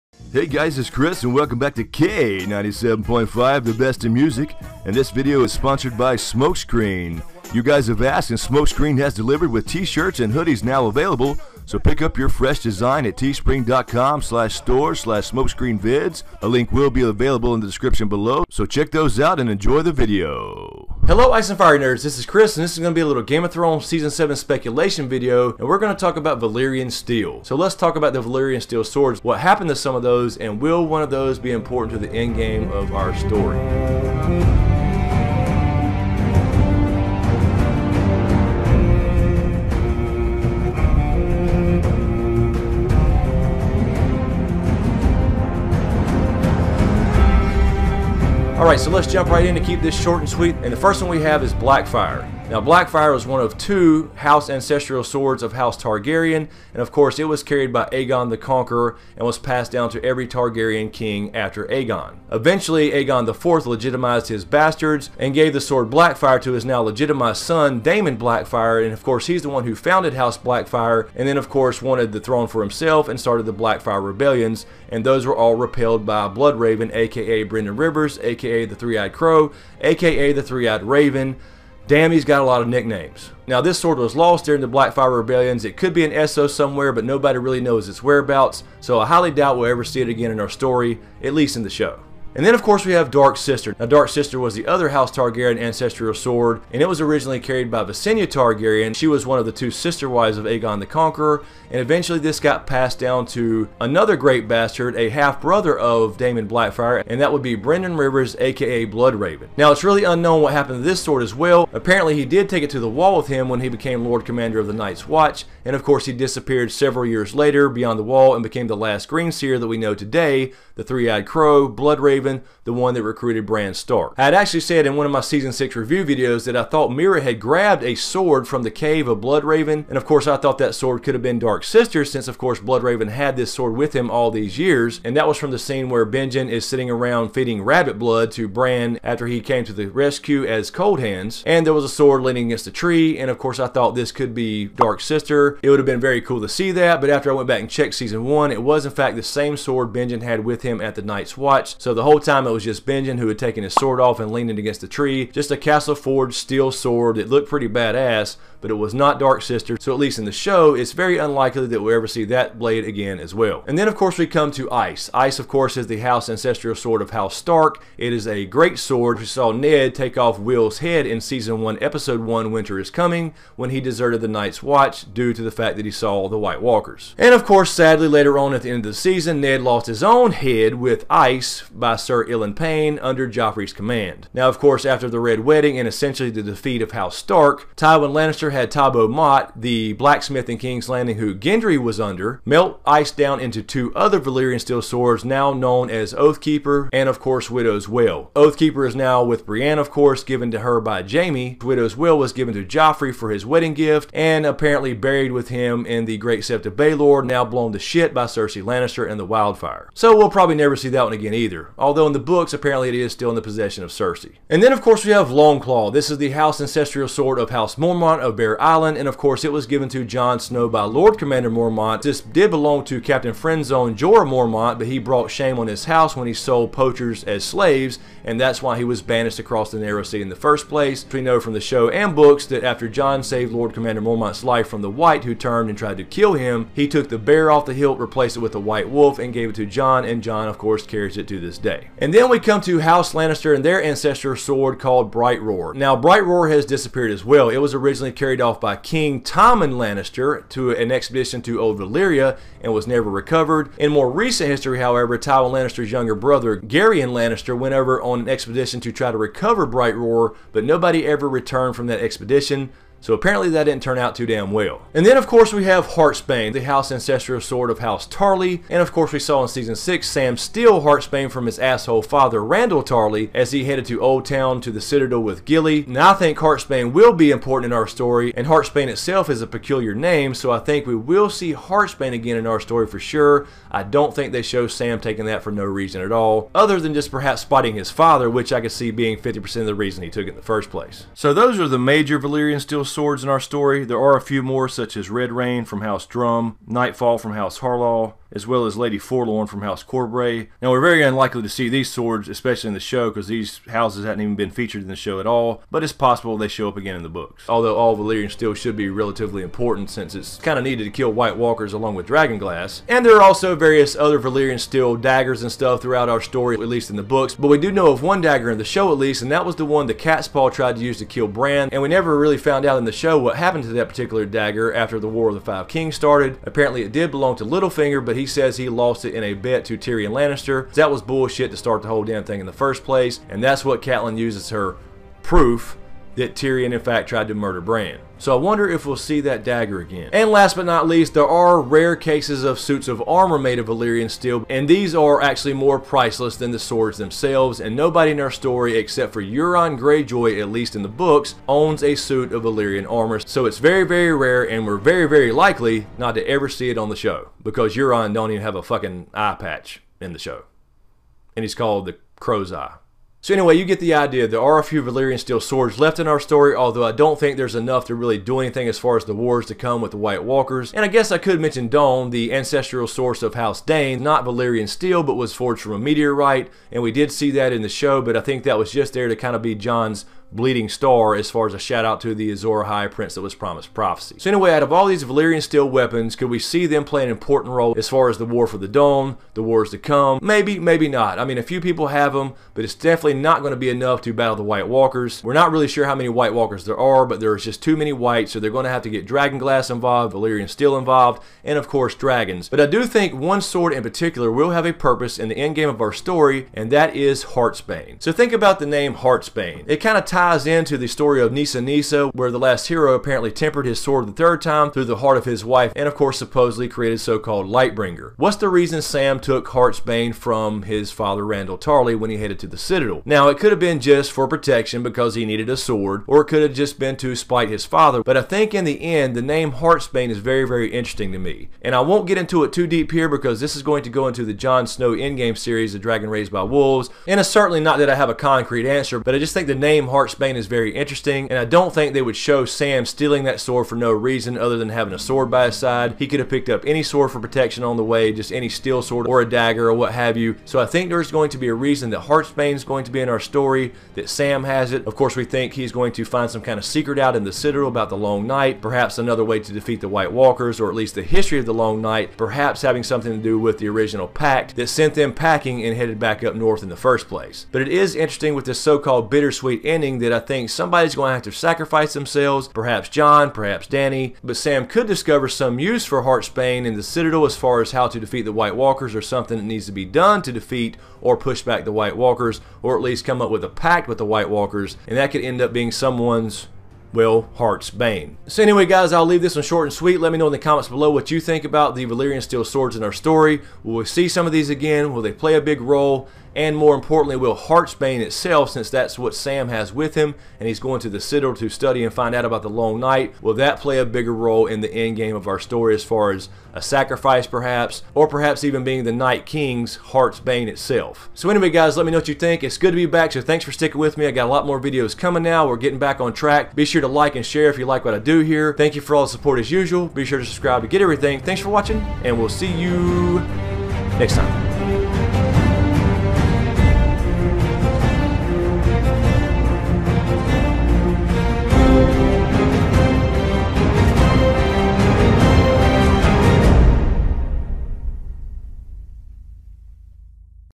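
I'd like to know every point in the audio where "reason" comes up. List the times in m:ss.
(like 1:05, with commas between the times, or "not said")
4:45, 4:49, 6:58, 7:23, 7:31.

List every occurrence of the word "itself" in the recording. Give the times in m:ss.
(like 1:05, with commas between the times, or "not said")
4:38, 8:17, 8:30.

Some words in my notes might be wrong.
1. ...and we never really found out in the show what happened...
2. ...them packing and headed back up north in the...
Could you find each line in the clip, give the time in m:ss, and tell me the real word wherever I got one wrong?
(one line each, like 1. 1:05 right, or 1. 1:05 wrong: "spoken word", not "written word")
1. 5:21 right
2. 7:44 right.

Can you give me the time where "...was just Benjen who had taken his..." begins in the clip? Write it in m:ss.
2:32.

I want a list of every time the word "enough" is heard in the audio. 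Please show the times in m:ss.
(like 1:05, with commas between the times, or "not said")
6:07, 6:33.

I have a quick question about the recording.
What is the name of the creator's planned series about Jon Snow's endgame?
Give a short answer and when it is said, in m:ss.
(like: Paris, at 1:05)
The Dragon Raised by Wolves, at 7:15.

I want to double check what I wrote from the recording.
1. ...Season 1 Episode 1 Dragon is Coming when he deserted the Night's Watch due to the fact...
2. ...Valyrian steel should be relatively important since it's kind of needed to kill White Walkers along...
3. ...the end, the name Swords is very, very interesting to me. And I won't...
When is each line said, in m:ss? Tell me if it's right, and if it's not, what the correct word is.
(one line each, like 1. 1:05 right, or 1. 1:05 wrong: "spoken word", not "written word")
1. 2:51 wrong: "Winter", not "Dragon"
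2. 5:07 right
3. 7:08 wrong: "Heartsbane", not "Swords".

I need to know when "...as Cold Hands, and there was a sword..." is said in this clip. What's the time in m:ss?
2:20.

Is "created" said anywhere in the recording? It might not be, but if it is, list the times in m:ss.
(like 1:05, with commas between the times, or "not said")
6:56.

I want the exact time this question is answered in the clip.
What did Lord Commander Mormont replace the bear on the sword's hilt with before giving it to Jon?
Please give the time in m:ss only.
3:58.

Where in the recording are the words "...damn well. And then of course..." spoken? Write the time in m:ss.
4:24.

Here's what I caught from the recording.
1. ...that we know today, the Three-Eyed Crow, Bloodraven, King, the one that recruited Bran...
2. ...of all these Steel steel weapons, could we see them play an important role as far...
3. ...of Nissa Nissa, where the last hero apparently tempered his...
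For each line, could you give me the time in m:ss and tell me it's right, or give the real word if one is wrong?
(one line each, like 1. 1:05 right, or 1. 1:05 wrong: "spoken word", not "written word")
1. 1:59 wrong: "Craven", not "King"
2. 6:24 wrong: "Valyrian", not "Steel"
3. 6:51 right.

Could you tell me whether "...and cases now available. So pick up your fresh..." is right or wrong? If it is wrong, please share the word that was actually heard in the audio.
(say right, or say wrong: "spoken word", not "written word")
wrong: "hoodies", not "cases".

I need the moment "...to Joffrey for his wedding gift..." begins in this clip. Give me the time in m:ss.
3:22.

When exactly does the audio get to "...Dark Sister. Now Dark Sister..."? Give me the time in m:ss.
1:33.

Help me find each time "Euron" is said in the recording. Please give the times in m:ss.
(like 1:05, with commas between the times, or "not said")
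5:49, 5:57.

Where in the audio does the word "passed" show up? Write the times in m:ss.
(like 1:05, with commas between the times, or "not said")
0:59, 1:42.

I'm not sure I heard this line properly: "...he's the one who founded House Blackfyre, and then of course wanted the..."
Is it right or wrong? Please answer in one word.
right.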